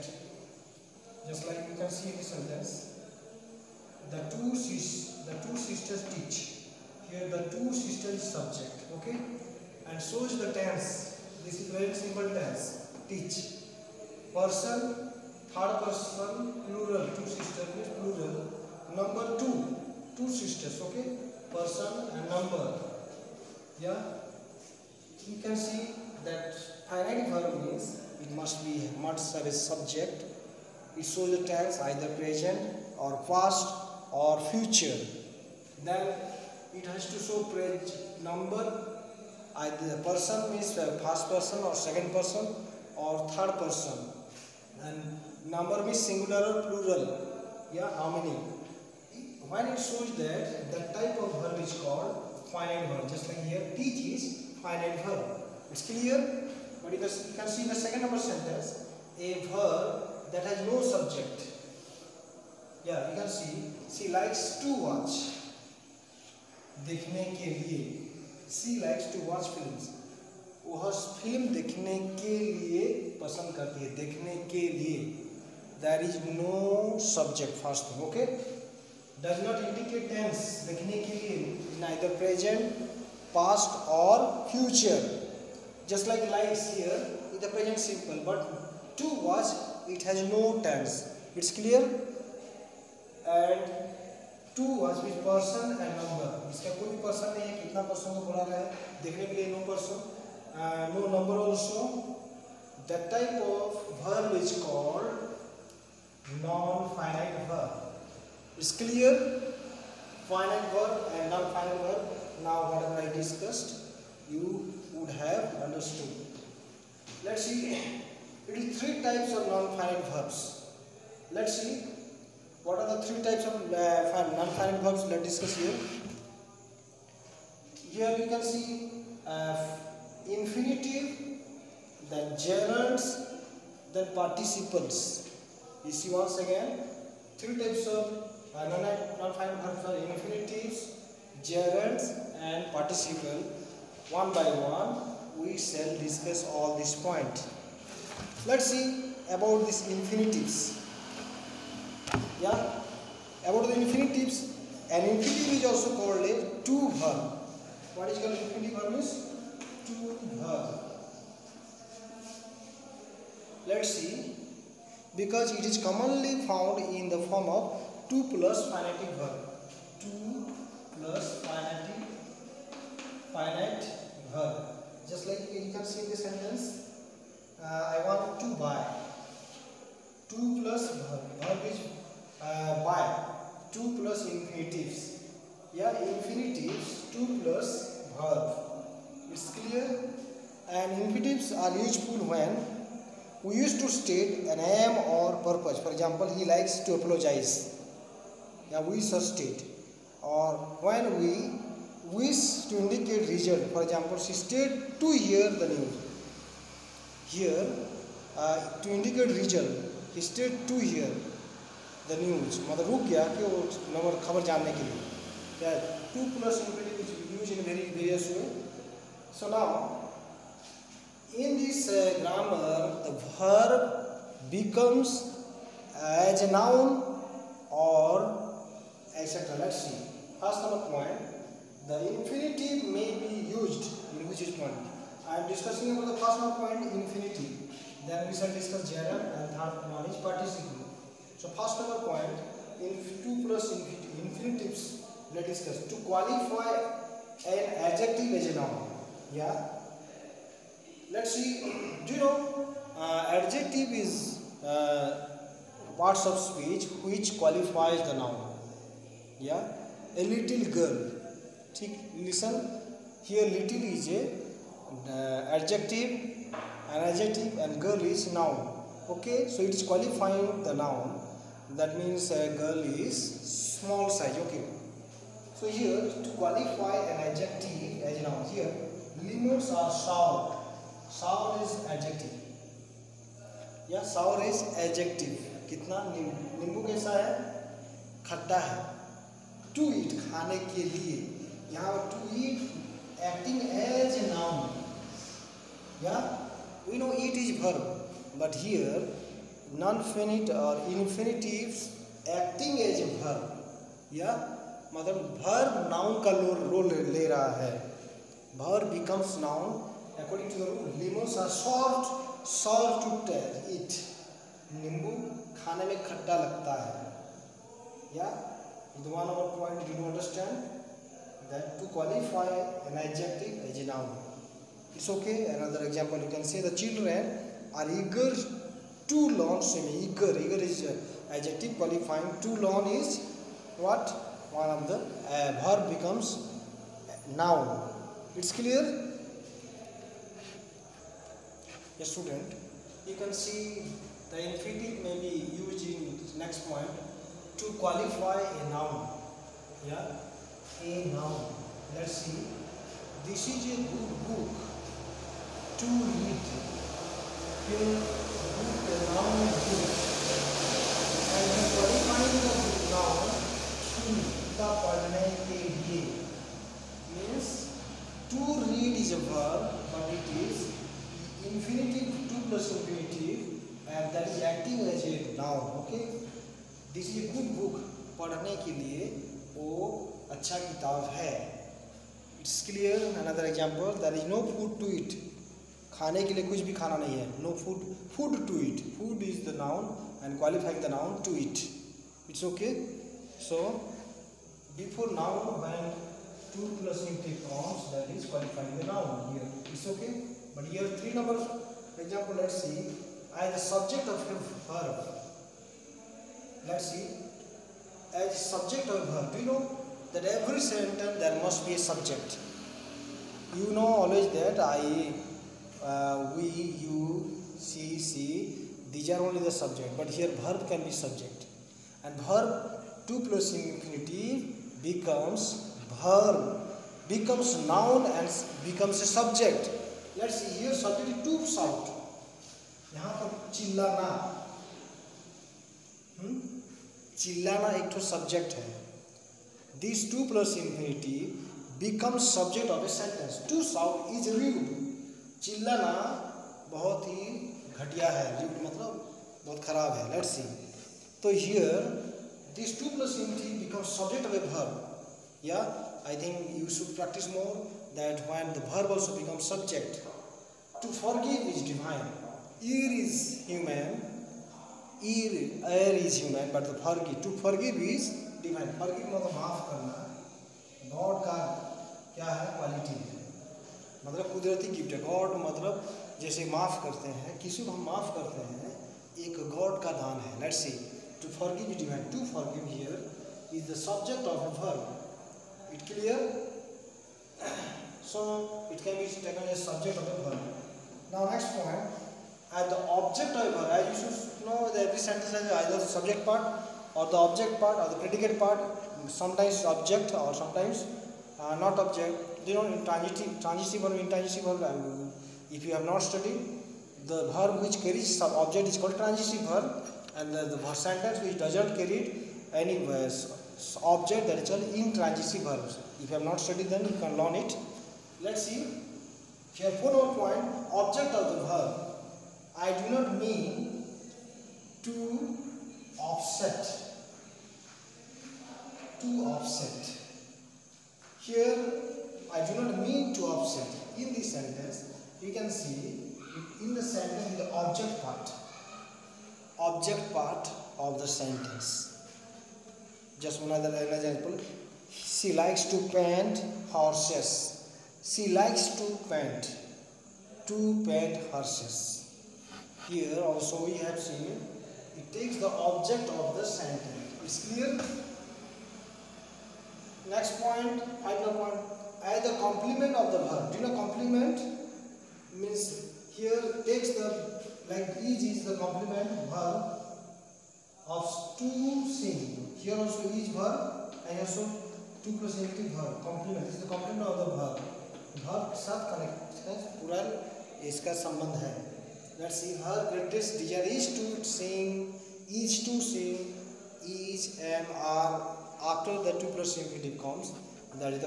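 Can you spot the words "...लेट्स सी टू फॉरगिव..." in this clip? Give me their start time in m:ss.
8:00.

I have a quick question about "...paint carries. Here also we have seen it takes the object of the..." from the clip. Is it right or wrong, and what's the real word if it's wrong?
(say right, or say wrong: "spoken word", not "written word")
wrong: "horses", not "carries".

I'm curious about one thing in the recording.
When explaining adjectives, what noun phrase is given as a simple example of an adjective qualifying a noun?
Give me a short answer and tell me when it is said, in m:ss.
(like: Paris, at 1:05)
A little girl, at 4:20.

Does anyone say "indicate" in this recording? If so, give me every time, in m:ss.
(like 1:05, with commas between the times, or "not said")
3:22, 3:28.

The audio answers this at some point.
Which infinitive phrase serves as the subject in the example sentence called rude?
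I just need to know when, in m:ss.
7:23.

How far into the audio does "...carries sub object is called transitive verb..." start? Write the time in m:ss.
8:27.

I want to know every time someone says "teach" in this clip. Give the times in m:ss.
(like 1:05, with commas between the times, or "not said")
0:06, 0:13, 0:53.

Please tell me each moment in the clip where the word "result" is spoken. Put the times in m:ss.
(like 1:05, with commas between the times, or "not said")
3:23, 3:29.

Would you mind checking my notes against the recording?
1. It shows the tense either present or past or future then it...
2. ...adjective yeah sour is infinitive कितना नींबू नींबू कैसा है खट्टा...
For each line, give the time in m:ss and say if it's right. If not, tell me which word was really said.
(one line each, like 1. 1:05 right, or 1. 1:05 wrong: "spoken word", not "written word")
1. 0:30 right
2. 4:41 wrong: "adjective", not "infinitive".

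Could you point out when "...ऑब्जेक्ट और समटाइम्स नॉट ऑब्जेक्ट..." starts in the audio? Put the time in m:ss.
8:19.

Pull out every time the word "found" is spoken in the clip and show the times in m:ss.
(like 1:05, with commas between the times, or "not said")
2:46.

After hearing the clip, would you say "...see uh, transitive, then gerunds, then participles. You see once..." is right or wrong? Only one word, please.
wrong.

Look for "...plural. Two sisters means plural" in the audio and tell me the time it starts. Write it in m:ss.
0:16.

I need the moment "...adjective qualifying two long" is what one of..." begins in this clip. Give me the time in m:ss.
5:31.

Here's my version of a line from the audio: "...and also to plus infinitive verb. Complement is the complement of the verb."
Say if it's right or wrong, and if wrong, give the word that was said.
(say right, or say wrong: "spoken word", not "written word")
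right.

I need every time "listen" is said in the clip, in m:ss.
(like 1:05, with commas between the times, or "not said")
4:22.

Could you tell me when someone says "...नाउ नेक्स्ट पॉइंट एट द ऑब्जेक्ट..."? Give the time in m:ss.
8:11.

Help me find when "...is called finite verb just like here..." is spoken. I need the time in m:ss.
0:51.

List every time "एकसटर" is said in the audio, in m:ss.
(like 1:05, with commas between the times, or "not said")
3:49.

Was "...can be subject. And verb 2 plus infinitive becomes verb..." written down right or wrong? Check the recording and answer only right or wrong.
right.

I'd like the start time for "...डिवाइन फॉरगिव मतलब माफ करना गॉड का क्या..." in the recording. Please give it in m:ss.
7:48.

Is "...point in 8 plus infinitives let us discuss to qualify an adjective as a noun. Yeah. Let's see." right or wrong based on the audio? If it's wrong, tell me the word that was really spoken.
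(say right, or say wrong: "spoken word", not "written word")
wrong: "2", not "8".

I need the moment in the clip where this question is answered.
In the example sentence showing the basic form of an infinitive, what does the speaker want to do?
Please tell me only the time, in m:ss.
2:57.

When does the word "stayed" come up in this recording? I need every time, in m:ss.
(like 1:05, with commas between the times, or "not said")
3:24, 3:30.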